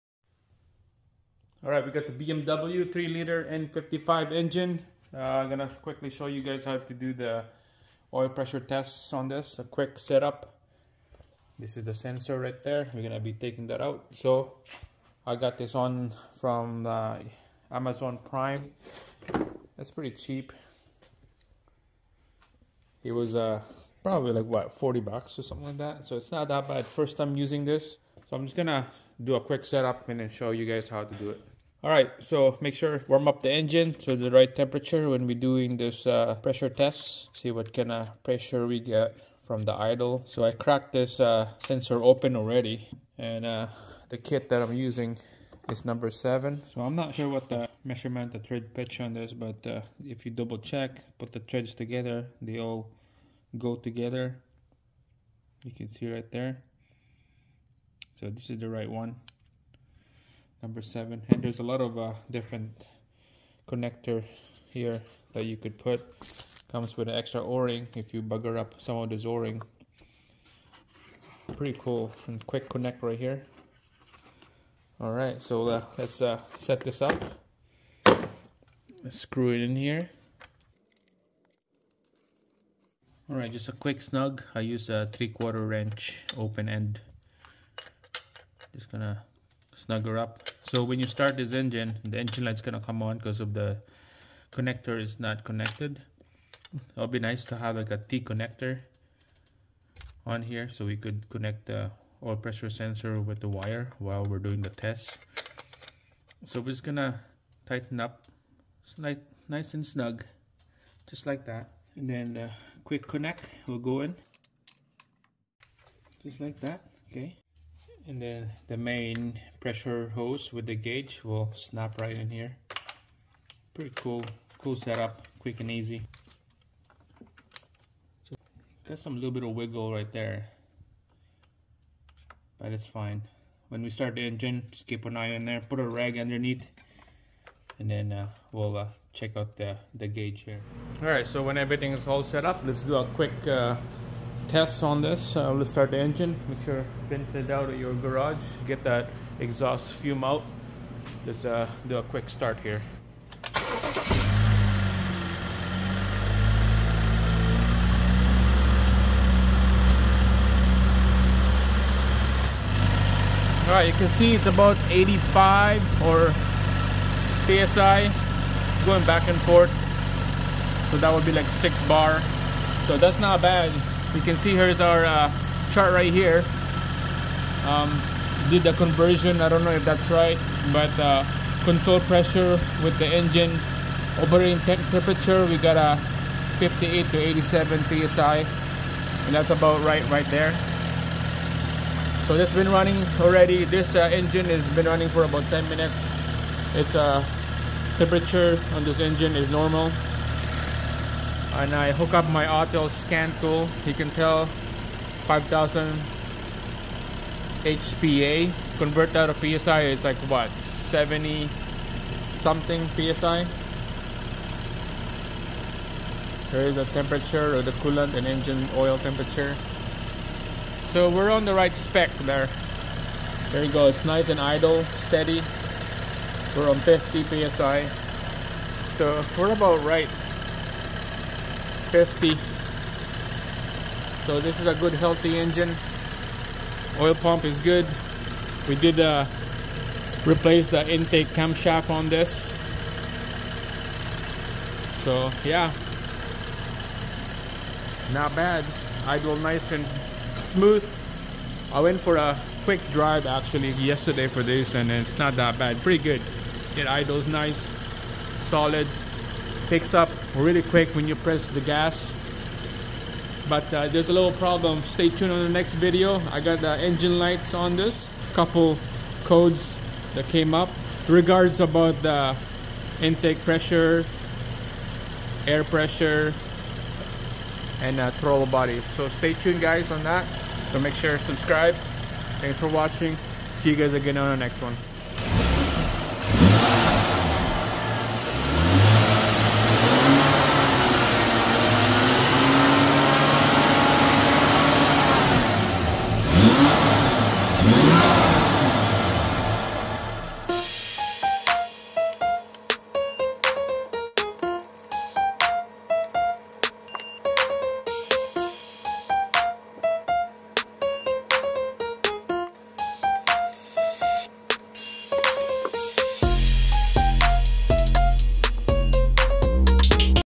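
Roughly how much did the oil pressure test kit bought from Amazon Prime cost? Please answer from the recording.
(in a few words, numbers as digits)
40 bucks.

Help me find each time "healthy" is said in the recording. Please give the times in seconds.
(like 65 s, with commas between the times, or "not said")
234 s.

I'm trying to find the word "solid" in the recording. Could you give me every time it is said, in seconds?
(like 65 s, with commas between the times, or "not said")
258 s.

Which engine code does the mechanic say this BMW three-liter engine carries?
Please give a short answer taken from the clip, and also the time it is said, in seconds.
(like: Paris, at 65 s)
N55, at 3 s.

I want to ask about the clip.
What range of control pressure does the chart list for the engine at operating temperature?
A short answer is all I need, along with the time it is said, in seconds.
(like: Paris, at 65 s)
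58 to 87 psi, at 186 s.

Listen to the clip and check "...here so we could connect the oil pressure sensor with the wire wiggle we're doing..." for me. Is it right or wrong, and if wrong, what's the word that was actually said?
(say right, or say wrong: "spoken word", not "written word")
wrong: "while", not "wiggle".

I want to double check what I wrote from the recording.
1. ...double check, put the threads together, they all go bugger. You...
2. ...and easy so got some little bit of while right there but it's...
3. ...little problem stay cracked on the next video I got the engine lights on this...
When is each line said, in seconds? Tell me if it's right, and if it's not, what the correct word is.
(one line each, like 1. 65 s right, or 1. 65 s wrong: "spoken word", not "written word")
1. 50 s wrong: "together", not "bugger"
2. 125 s wrong: "wiggle", not "while"
3. 264 s wrong: "tuned", not "cracked".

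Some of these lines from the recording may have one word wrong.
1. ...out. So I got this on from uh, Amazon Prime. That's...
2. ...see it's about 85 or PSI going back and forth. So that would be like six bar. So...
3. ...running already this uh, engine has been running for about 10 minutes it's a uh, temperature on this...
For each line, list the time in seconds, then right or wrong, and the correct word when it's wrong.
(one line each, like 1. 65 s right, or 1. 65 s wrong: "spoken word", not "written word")
1. 13 s right
2. 164 s right
3. 192 s right.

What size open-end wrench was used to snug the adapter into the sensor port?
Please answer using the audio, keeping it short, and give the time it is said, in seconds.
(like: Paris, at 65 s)
3/4, at 85 s.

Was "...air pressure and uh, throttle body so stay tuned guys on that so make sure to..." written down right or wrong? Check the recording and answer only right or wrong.
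right.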